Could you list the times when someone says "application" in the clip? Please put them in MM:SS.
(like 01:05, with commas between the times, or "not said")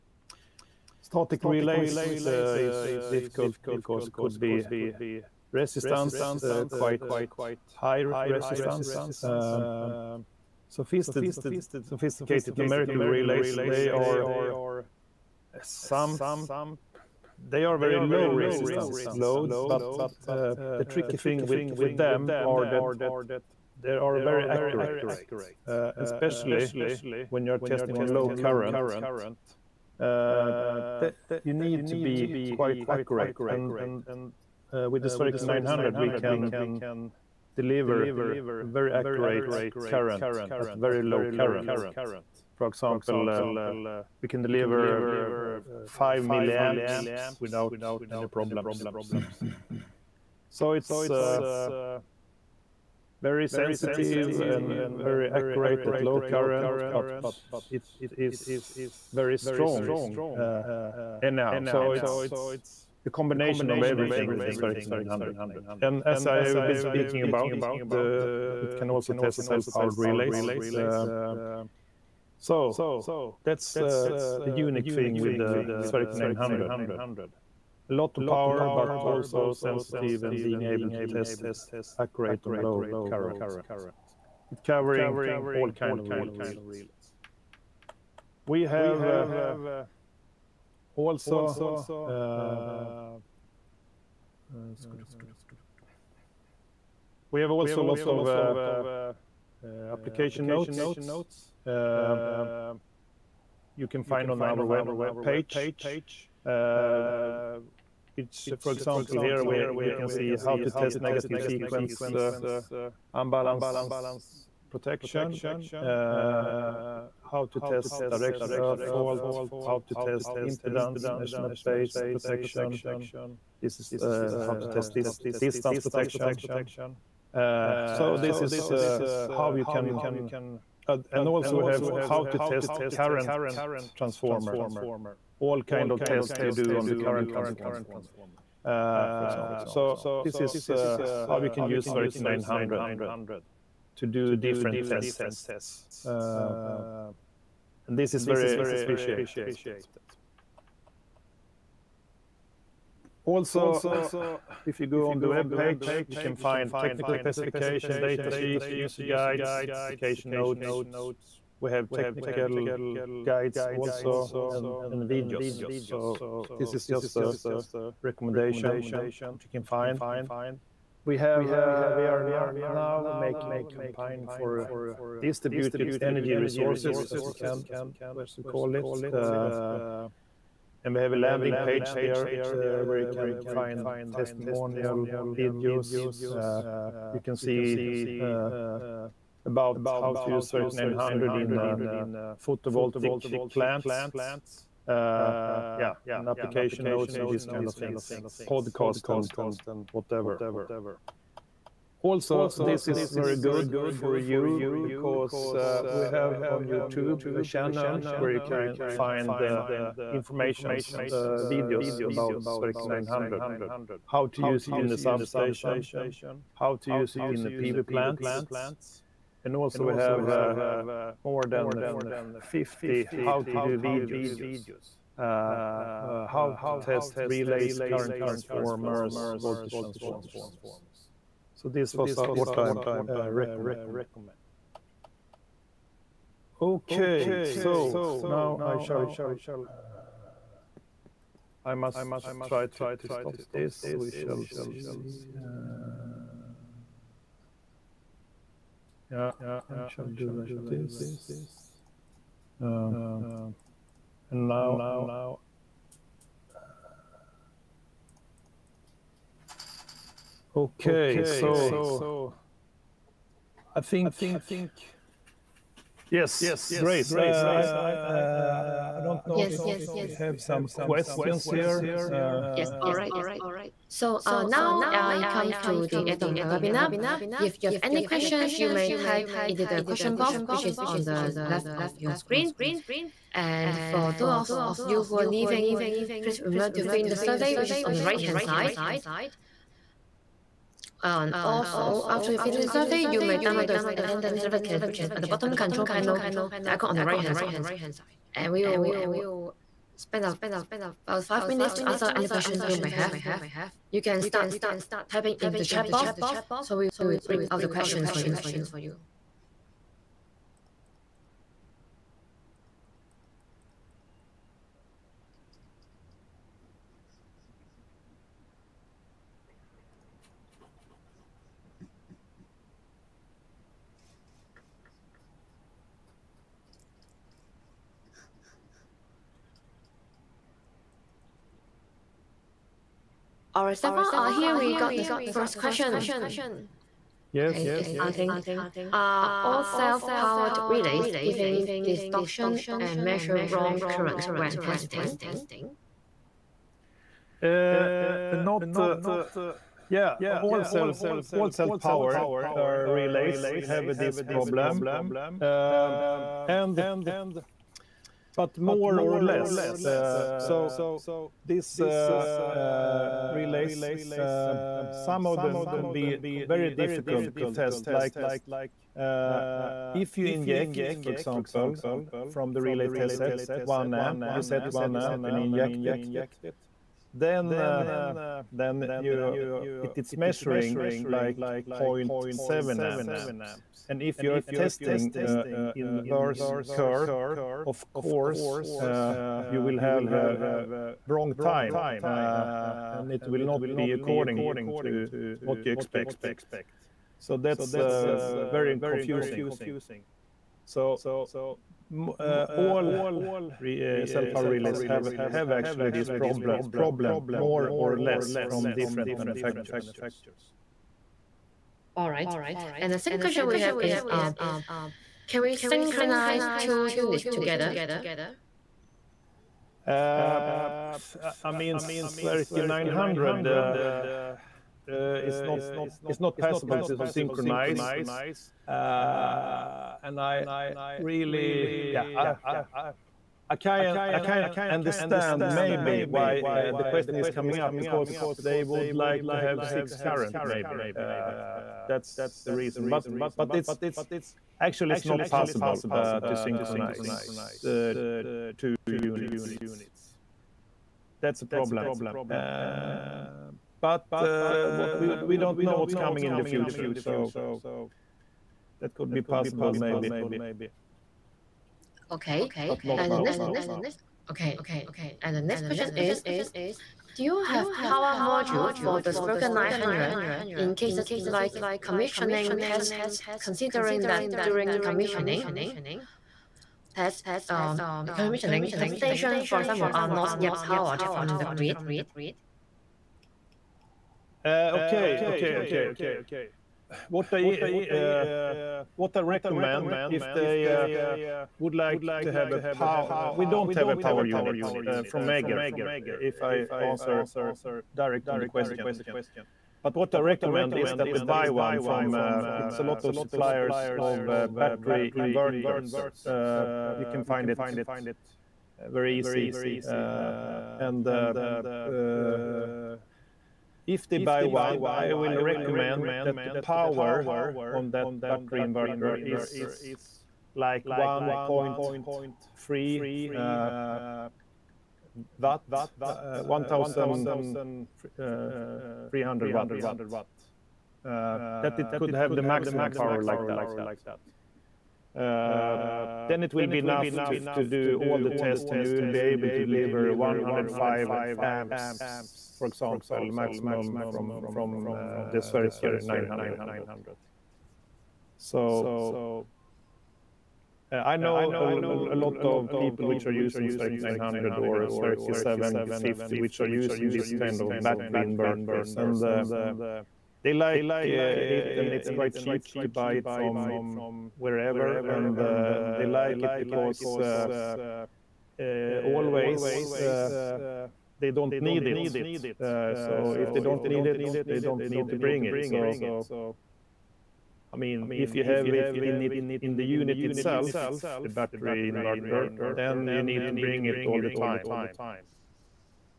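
01:39, 02:39, 03:16.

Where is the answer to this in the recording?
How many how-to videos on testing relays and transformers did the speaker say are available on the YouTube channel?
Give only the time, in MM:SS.
03:41.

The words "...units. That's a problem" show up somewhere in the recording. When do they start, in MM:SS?
07:29.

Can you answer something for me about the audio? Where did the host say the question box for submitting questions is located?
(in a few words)
on the left.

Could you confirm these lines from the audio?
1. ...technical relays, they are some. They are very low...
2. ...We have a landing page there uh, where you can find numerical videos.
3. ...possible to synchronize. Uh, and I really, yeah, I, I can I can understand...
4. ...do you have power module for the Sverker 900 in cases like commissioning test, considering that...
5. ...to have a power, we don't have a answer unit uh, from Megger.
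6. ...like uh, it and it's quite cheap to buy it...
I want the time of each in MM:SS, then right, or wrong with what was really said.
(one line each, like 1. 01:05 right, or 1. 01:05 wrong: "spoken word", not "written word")
1. 00:12 wrong: "numerical", not "technical"
2. 03:00 wrong: "testimonial", not "numerical"
3. 07:06 right
4. 07:47 right
5. 08:12 wrong: "power", not "answer"
6. 09:20 right.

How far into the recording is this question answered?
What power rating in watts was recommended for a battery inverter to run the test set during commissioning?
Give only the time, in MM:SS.
08:46.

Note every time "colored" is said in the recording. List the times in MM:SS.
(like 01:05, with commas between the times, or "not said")
not said.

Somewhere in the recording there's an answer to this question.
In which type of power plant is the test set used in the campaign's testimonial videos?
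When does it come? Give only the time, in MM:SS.
03:12.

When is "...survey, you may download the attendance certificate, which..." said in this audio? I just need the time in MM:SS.
04:52.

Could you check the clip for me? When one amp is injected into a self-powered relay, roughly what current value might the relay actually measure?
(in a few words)
0.7 amps.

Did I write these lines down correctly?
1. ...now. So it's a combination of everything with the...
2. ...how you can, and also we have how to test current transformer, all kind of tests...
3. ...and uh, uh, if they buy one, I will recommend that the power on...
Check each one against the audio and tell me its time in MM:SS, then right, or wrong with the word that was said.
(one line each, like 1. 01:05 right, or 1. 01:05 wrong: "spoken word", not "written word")
1. 01:01 right
2. 02:09 right
3. 08:30 right.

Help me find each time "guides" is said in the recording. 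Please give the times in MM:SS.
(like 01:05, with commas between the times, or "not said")
02:39, 02:43.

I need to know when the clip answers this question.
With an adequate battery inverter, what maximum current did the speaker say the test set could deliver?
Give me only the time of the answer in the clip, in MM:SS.
09:00.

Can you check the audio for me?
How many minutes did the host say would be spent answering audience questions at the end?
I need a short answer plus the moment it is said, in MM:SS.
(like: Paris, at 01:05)
5, at 05:01.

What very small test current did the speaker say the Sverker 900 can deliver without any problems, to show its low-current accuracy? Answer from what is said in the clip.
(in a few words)
5 milliamps.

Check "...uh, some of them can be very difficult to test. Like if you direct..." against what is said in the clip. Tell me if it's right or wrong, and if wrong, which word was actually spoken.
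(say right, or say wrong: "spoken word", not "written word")
wrong: "inject", not "direct".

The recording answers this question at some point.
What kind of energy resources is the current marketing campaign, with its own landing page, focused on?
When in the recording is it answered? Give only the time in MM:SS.
02:55.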